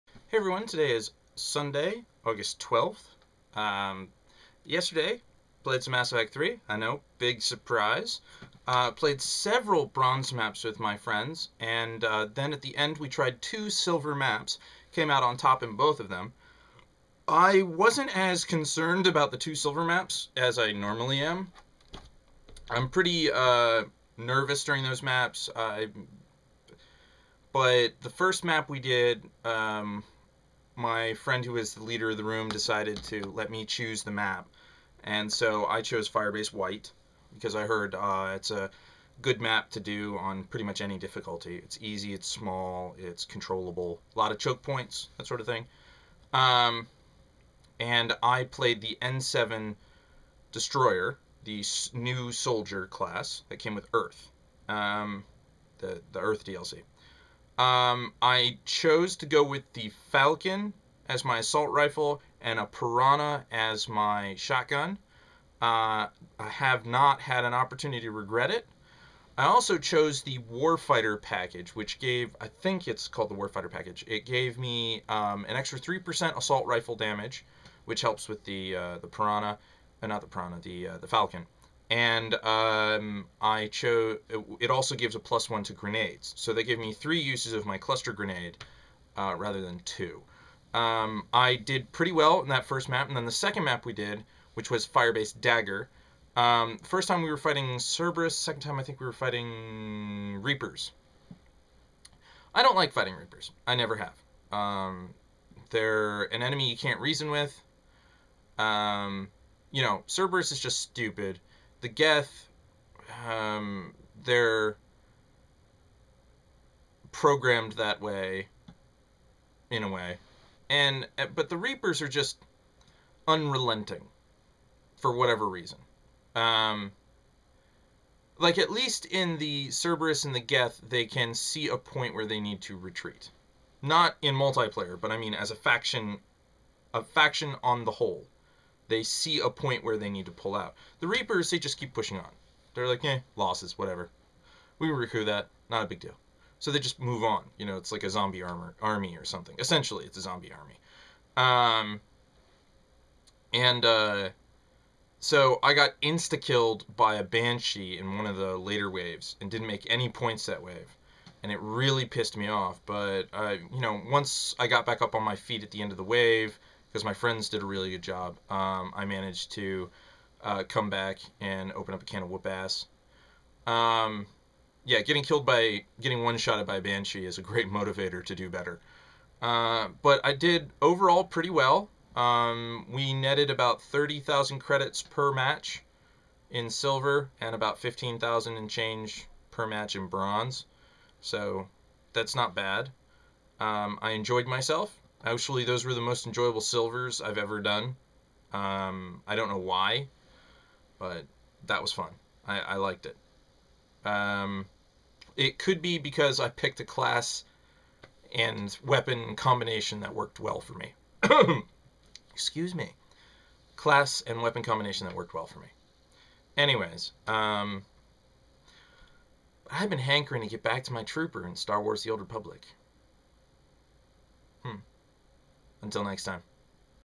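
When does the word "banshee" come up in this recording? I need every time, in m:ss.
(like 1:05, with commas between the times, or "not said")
2:37, 2:56.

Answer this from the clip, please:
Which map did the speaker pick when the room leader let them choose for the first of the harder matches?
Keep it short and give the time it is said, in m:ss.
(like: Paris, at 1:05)
Firebase White, at 0:36.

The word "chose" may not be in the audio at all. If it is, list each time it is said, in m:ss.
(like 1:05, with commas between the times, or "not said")
0:35, 0:58, 1:09, 1:23.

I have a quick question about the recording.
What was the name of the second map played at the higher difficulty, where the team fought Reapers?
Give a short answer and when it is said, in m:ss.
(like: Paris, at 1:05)
Firebase Dagger, at 1:34.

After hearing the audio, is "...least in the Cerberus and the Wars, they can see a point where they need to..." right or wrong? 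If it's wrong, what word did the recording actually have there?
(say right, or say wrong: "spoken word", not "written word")
wrong: "Geth", not "Wars".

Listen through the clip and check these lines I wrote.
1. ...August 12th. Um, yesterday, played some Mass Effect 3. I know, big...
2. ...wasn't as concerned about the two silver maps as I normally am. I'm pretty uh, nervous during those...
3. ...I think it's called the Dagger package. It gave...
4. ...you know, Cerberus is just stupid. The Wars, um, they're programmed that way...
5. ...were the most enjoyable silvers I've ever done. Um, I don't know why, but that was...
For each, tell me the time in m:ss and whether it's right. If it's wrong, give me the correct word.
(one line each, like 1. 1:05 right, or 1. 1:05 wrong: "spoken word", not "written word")
1. 0:02 right
2. 0:17 right
3. 1:12 wrong: "Warfighter", not "Dagger"
4. 1:49 wrong: "Geth", not "Wars"
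5. 3:15 right.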